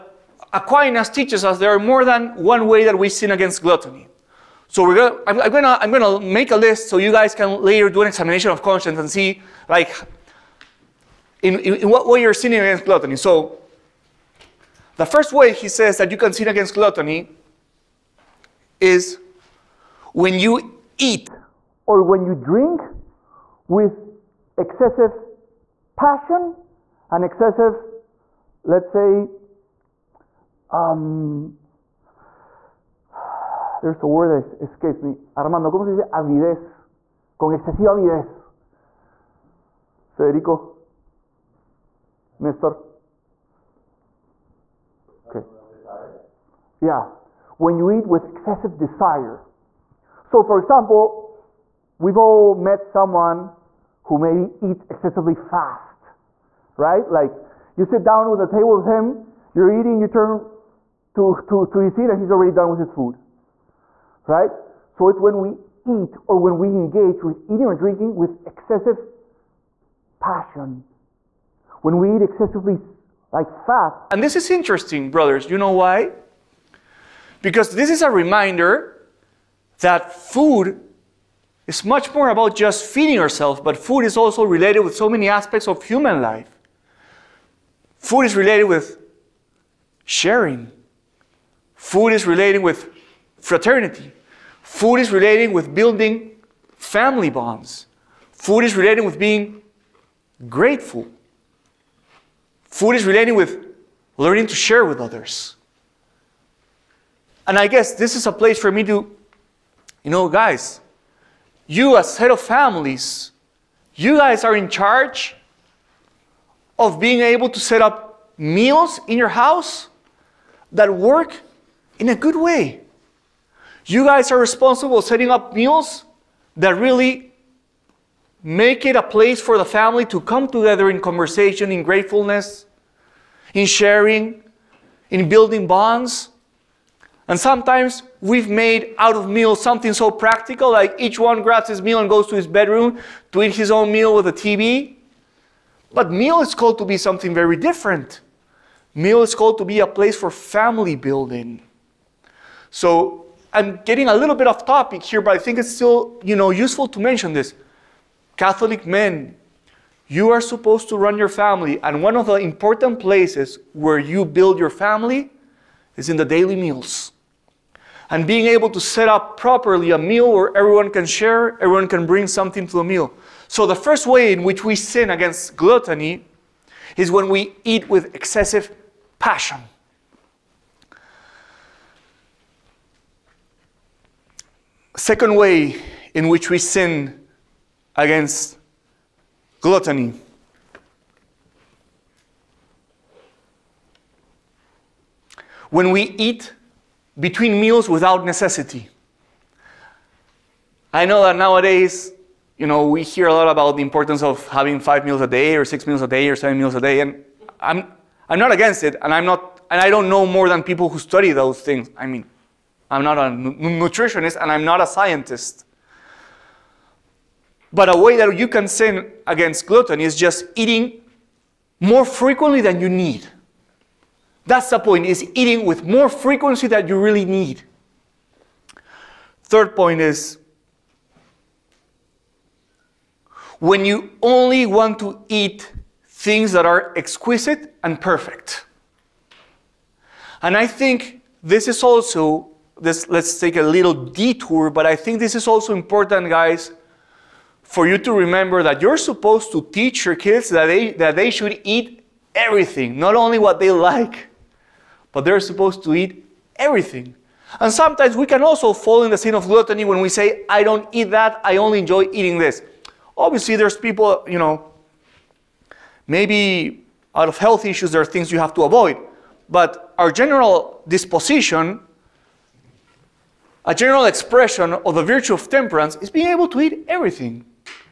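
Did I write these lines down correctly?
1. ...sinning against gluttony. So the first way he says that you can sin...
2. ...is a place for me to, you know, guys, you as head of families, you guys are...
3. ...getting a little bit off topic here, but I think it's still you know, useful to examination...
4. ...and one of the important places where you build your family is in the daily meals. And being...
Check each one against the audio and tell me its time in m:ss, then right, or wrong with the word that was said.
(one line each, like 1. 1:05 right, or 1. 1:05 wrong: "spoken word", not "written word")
1. 0:12 right
2. 1:48 right
3. 2:33 wrong: "mention", not "examination"
4. 2:41 right.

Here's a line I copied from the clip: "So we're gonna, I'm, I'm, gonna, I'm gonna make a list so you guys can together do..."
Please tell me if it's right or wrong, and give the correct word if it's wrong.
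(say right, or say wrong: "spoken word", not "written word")
wrong: "later", not "together".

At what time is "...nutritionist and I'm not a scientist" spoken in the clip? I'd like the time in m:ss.
3:33.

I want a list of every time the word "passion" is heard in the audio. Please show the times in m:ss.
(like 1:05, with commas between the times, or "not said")
0:25, 1:10, 2:59.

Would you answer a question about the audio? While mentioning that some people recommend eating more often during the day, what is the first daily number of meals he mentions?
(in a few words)
5.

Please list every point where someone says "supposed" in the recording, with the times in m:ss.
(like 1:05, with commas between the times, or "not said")
2:40, 4:08, 4:15.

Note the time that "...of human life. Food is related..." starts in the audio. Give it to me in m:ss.
1:25.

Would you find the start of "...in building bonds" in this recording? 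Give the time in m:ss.
2:15.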